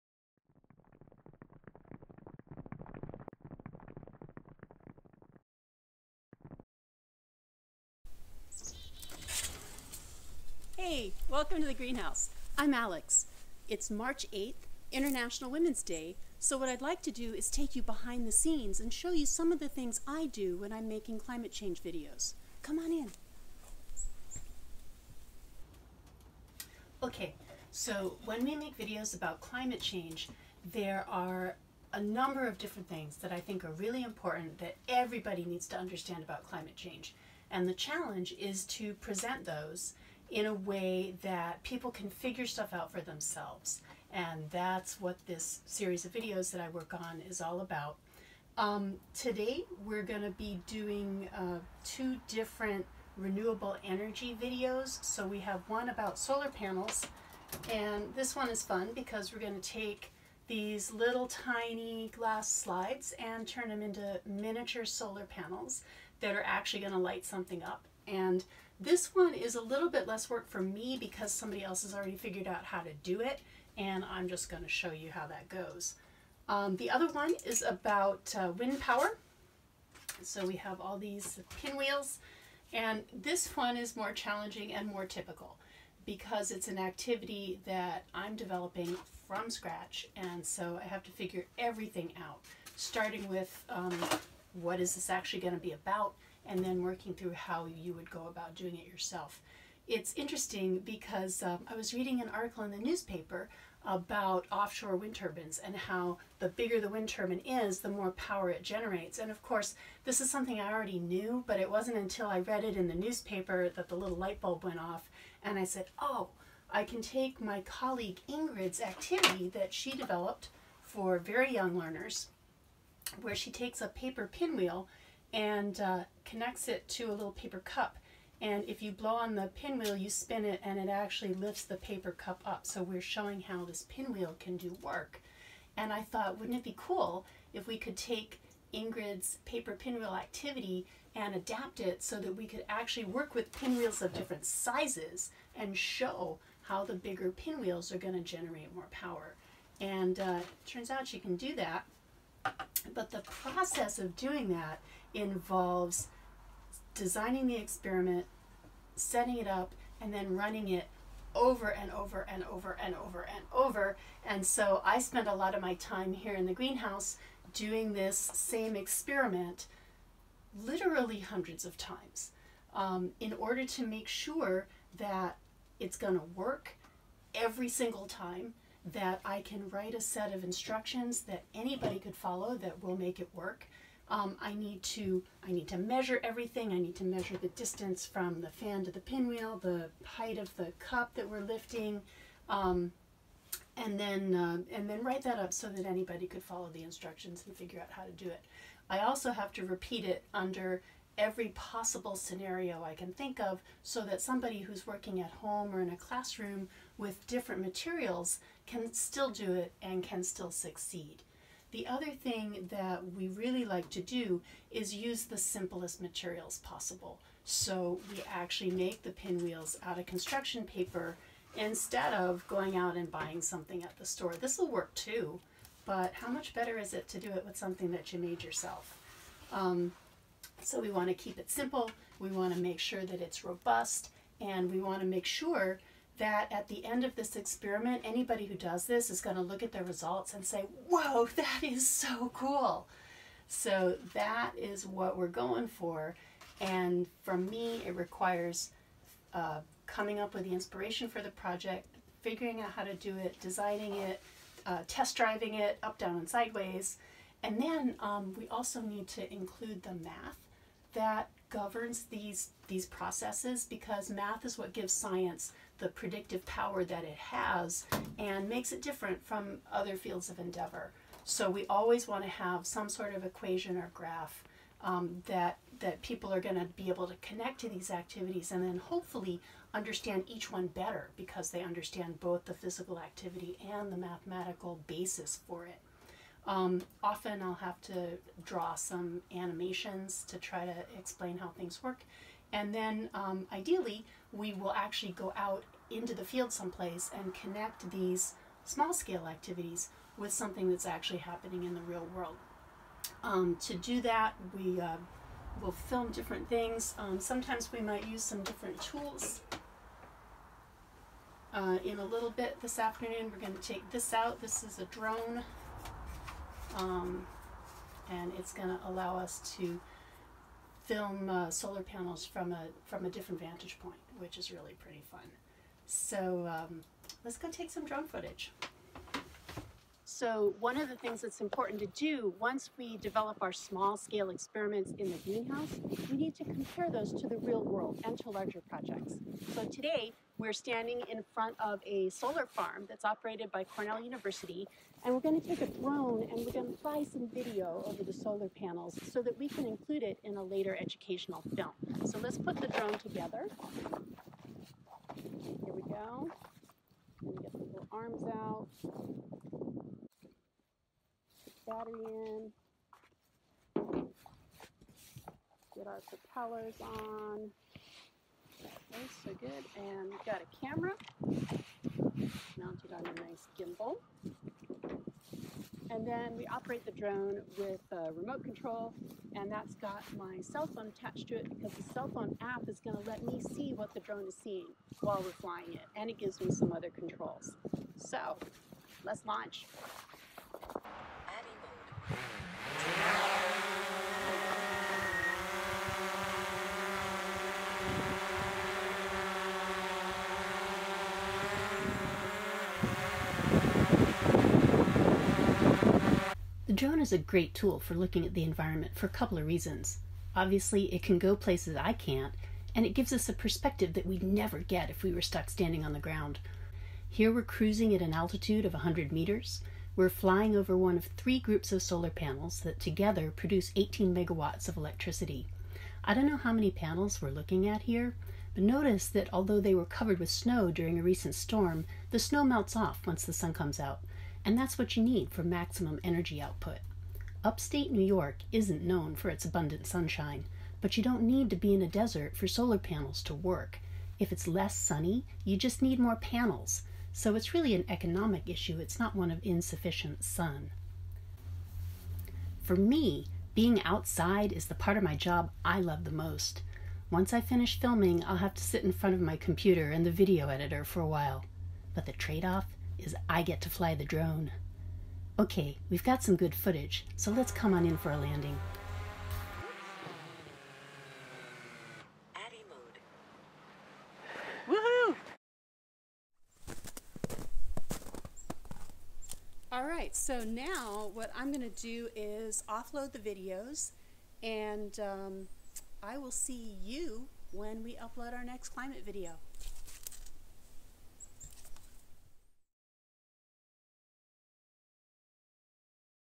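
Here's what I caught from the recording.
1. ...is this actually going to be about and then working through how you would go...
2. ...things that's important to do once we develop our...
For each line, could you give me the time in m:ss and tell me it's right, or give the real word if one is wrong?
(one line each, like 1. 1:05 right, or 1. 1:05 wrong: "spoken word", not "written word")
1. 1:34 right
2. 5:30 right.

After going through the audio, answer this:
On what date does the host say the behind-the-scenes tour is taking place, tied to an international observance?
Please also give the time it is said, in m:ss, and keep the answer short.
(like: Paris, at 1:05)
March 8th, at 0:13.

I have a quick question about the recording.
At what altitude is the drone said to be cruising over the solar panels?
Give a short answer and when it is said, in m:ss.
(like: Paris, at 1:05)
100 meters, at 6:58.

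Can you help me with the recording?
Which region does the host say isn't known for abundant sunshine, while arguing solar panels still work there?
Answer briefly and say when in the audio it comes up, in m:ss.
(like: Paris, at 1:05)
Upstate New York, at 7:17.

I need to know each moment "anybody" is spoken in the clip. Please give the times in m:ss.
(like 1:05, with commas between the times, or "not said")
3:01, 3:15, 3:58.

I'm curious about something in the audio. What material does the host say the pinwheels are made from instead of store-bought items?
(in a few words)
construction paper.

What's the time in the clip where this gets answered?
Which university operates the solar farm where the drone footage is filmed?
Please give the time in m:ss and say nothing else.
5:43.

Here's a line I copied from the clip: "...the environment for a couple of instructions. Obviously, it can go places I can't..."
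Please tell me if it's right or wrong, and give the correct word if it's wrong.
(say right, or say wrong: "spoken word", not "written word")
wrong: "reasons", not "instructions".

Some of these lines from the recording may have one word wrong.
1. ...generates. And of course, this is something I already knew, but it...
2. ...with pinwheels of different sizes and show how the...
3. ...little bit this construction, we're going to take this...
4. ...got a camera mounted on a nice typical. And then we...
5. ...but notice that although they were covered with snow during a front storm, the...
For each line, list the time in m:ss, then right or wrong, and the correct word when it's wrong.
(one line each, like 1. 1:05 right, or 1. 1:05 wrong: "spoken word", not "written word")
1. 1:48 right
2. 2:23 right
3. 5:12 wrong: "afternoon", not "construction"
4. 6:10 wrong: "gimbal", not "typical"
5. 7:08 wrong: "recent", not "front".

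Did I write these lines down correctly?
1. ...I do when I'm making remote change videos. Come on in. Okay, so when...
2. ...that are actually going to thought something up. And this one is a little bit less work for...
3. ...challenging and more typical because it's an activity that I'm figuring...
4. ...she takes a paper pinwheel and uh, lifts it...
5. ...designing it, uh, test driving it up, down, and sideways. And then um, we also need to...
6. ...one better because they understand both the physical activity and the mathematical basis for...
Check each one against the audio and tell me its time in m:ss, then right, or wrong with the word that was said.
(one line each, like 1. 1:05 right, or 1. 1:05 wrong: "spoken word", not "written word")
1. 0:20 wrong: "climate", not "remote"
2. 1:06 wrong: "light", not "thought"
3. 1:24 wrong: "developing", not "figuring"
4. 2:03 wrong: "connects", not "lifts"
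5. 4:13 right
6. 4:40 right.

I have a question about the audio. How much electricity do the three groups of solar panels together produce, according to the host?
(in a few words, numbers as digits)
18 megawatts.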